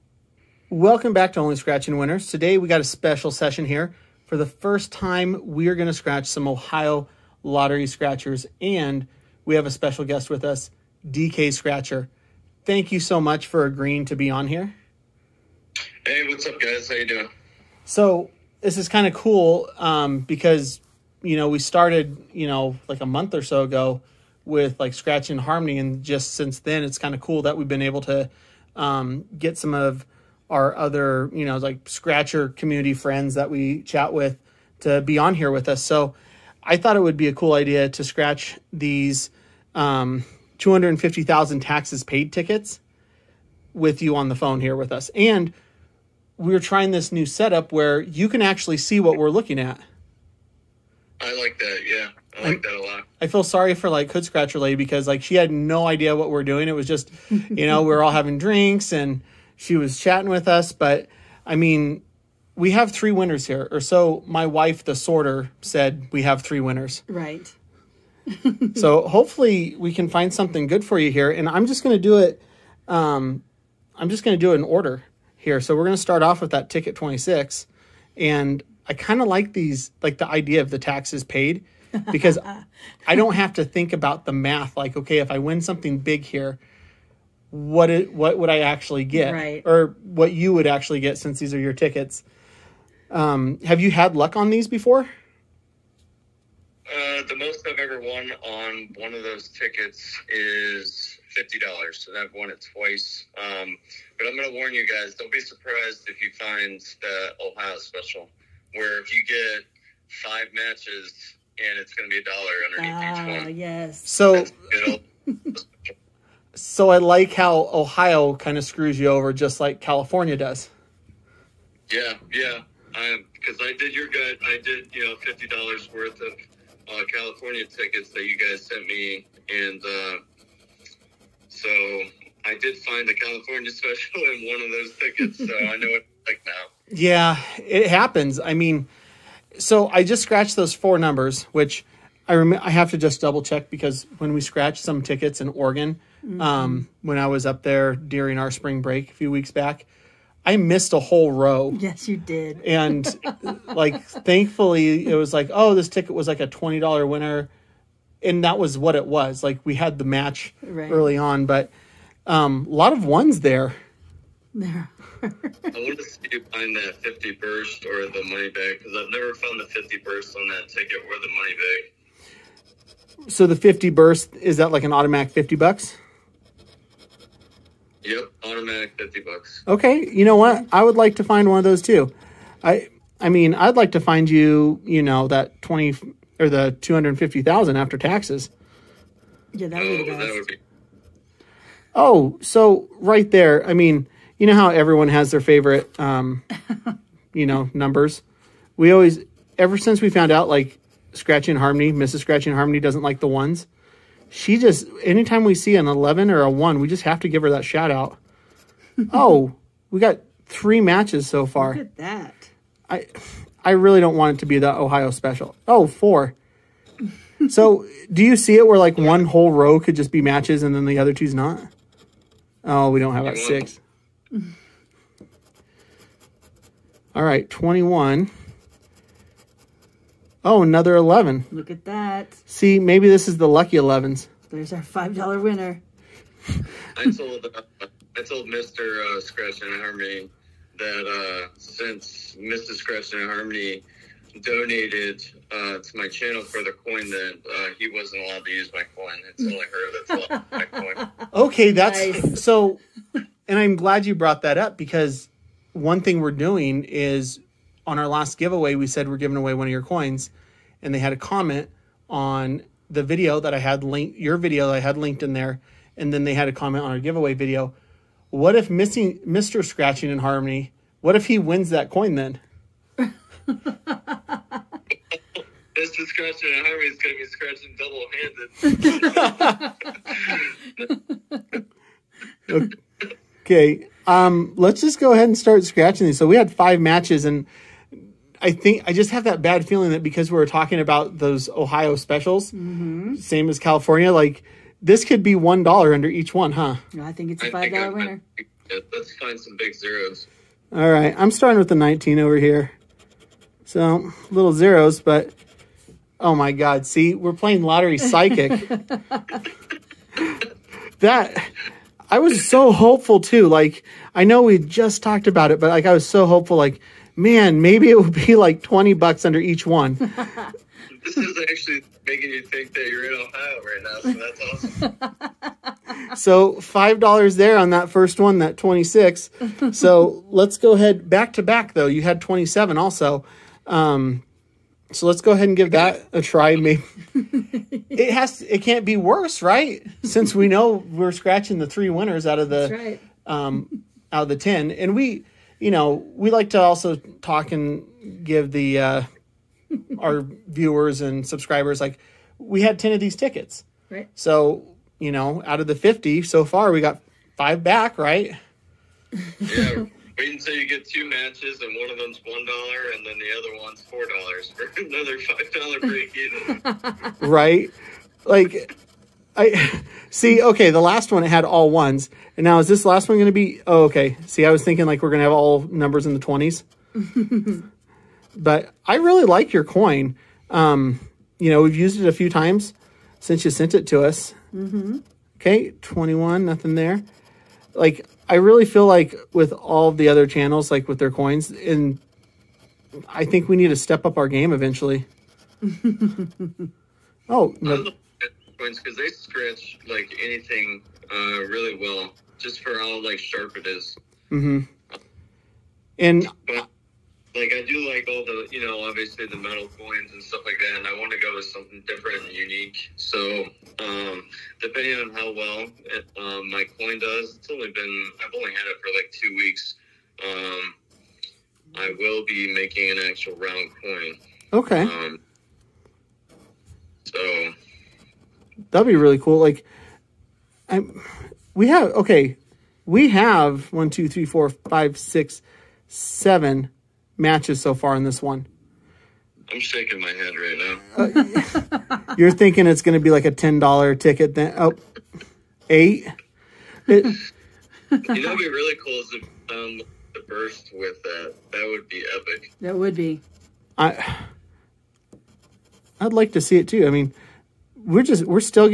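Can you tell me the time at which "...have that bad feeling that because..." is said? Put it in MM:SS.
04:49.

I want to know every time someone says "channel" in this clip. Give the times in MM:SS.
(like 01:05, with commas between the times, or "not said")
04:06, 06:30.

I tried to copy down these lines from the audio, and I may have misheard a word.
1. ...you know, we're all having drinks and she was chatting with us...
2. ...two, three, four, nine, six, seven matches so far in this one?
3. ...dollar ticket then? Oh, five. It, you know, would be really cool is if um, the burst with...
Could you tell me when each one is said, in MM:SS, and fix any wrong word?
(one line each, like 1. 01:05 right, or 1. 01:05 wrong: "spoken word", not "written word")
1. 00:57 right
2. 07:13 wrong: "five", not "nine"
3. 07:23 wrong: "eight", not "five".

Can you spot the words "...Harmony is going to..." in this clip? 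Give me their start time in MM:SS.
04:36.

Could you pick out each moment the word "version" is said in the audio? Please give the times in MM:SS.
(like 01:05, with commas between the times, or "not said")
not said.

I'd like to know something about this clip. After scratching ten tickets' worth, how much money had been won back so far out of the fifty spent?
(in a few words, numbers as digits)
$5.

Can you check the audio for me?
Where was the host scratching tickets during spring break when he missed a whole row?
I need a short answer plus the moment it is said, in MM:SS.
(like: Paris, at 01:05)
Oregon, at 02:25.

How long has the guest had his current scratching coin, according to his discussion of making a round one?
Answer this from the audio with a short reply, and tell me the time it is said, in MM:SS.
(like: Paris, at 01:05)
two weeks, at 06:59.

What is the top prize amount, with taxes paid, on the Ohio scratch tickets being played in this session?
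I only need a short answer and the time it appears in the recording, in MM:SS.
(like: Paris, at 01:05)
$250,000, at 00:40.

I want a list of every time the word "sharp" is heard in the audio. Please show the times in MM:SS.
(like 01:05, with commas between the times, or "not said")
06:43.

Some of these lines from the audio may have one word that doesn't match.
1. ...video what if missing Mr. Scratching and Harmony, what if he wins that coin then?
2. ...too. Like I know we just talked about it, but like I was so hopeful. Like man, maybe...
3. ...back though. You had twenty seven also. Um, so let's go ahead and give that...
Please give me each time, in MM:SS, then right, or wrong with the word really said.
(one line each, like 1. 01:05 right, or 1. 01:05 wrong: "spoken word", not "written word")
1. 04:27 right
2. 05:13 right
3. 05:31 right.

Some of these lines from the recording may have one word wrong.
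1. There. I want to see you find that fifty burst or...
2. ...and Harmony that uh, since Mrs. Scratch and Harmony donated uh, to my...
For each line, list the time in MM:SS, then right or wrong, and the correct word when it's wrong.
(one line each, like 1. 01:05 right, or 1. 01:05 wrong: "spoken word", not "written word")
1. 02:44 right
2. 03:59 right.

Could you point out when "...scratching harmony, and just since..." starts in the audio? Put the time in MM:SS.
00:24.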